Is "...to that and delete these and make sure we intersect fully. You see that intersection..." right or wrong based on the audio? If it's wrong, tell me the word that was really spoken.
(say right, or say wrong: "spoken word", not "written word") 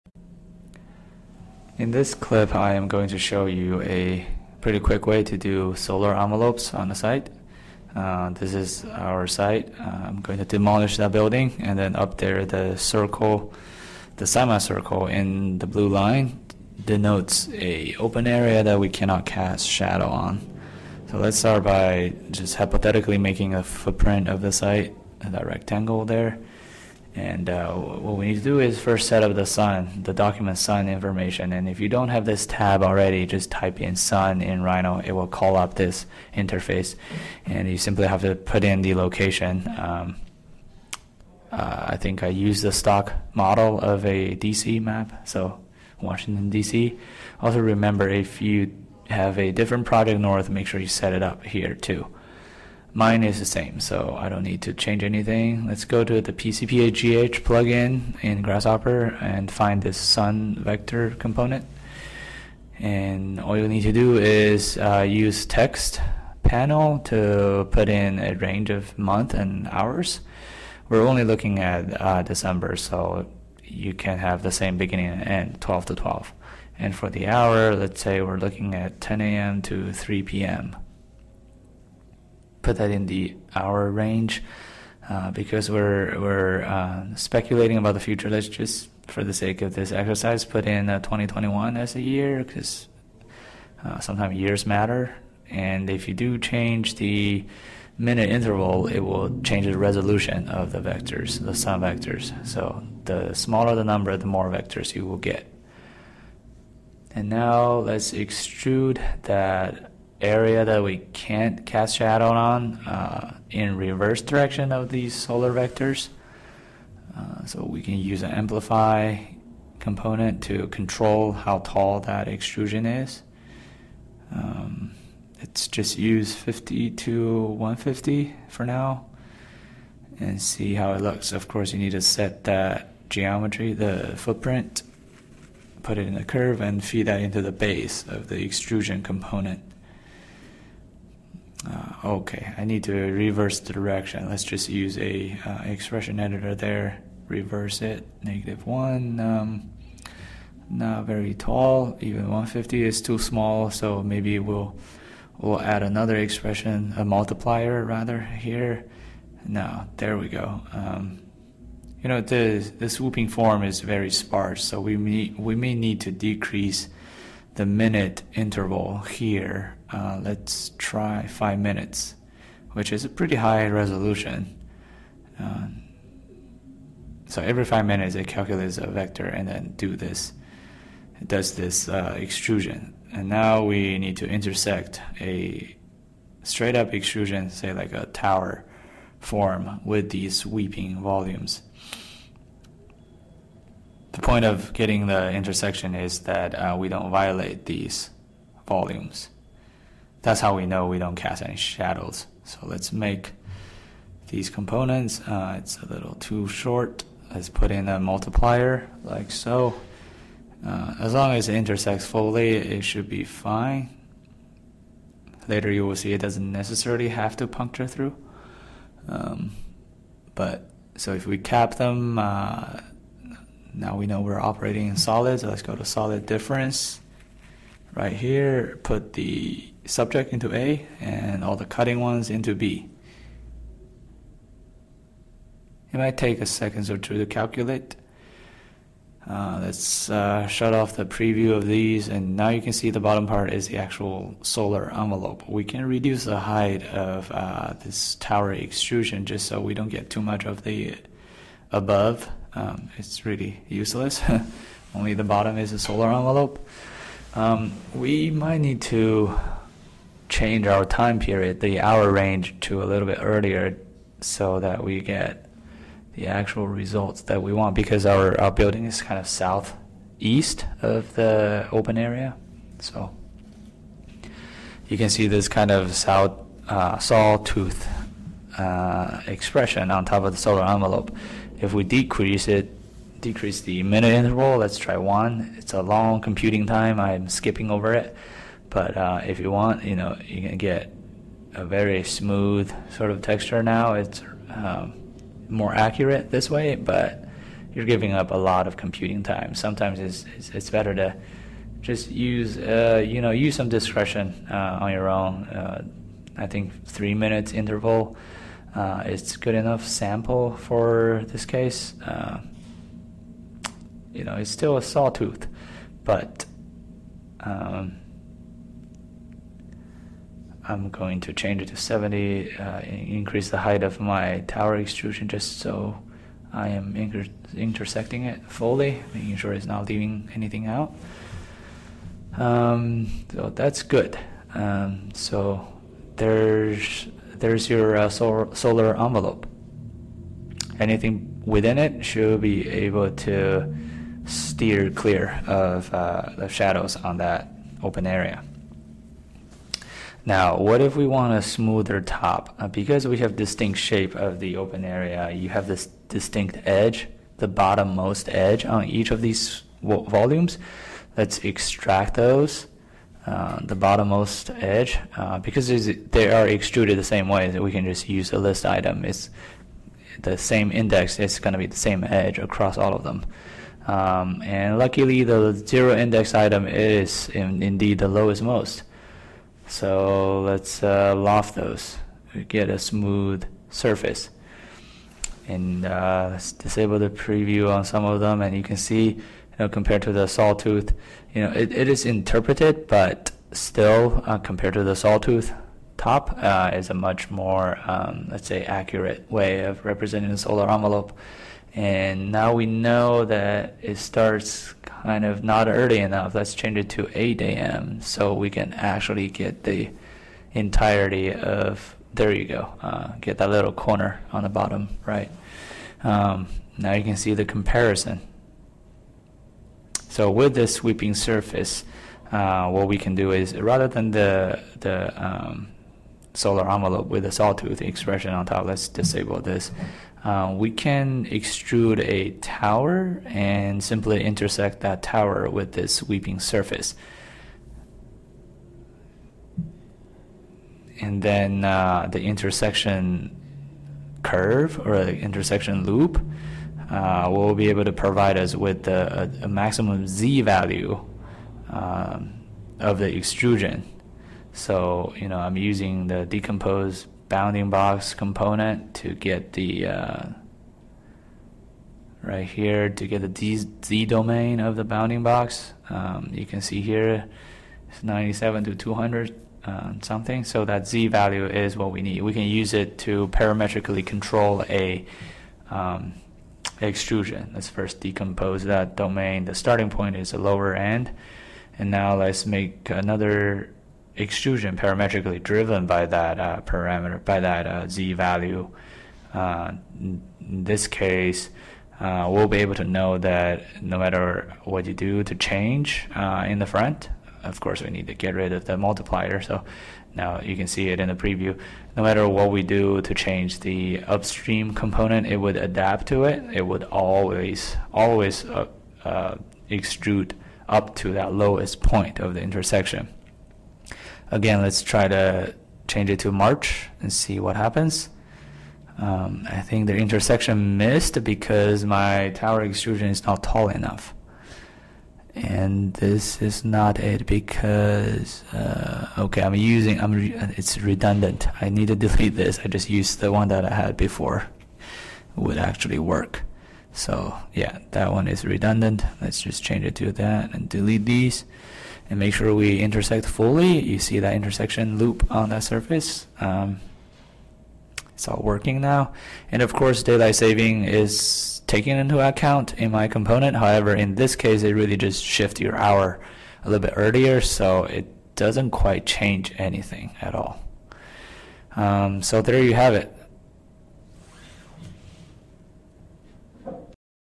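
right.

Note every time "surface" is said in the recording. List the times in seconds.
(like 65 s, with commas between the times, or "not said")
383 s, 421 s, 436 s, 545 s.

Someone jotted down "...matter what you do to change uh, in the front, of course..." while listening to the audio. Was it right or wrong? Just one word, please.
right.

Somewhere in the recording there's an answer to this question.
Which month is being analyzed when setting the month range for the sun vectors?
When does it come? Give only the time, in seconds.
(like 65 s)
72 s.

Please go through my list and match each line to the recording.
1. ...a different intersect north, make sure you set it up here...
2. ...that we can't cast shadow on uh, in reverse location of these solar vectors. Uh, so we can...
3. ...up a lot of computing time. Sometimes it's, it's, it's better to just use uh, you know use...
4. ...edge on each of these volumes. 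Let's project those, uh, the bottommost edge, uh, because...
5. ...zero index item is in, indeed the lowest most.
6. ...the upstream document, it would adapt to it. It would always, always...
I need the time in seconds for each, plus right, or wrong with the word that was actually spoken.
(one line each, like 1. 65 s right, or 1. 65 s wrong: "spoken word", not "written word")
1. 49 s wrong: "project", not "intersect"
2. 110 s wrong: "direction", not "location"
3. 298 s right
4. 358 s wrong: "extract", not "project"
5. 375 s right
6. 503 s wrong: "component", not "document".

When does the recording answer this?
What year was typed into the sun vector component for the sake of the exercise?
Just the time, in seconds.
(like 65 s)
90 s.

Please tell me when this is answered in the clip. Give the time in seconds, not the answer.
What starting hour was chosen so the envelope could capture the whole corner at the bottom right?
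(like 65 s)
407 s.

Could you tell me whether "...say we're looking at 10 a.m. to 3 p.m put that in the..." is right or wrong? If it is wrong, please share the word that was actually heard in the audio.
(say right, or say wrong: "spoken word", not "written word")
right.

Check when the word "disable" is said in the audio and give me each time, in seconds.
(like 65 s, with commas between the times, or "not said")
386 s, 428 s.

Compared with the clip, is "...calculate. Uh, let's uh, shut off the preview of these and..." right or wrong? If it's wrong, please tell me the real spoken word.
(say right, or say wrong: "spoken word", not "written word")
right.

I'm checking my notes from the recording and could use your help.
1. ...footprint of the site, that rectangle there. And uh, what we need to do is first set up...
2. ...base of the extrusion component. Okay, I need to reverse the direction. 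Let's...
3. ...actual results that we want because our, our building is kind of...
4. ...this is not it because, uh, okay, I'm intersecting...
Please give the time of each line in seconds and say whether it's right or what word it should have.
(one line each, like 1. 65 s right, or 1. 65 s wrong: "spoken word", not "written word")
1. 23 s right
2. 137 s right
3. 266 s right
4. 525 s wrong: "using", not "intersecting".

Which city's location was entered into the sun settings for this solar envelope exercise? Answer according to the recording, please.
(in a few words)
Washington, DC.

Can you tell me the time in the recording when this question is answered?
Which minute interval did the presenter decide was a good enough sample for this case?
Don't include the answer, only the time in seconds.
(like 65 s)
306 s.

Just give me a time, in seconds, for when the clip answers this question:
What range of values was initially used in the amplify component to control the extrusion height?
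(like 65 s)
126 s.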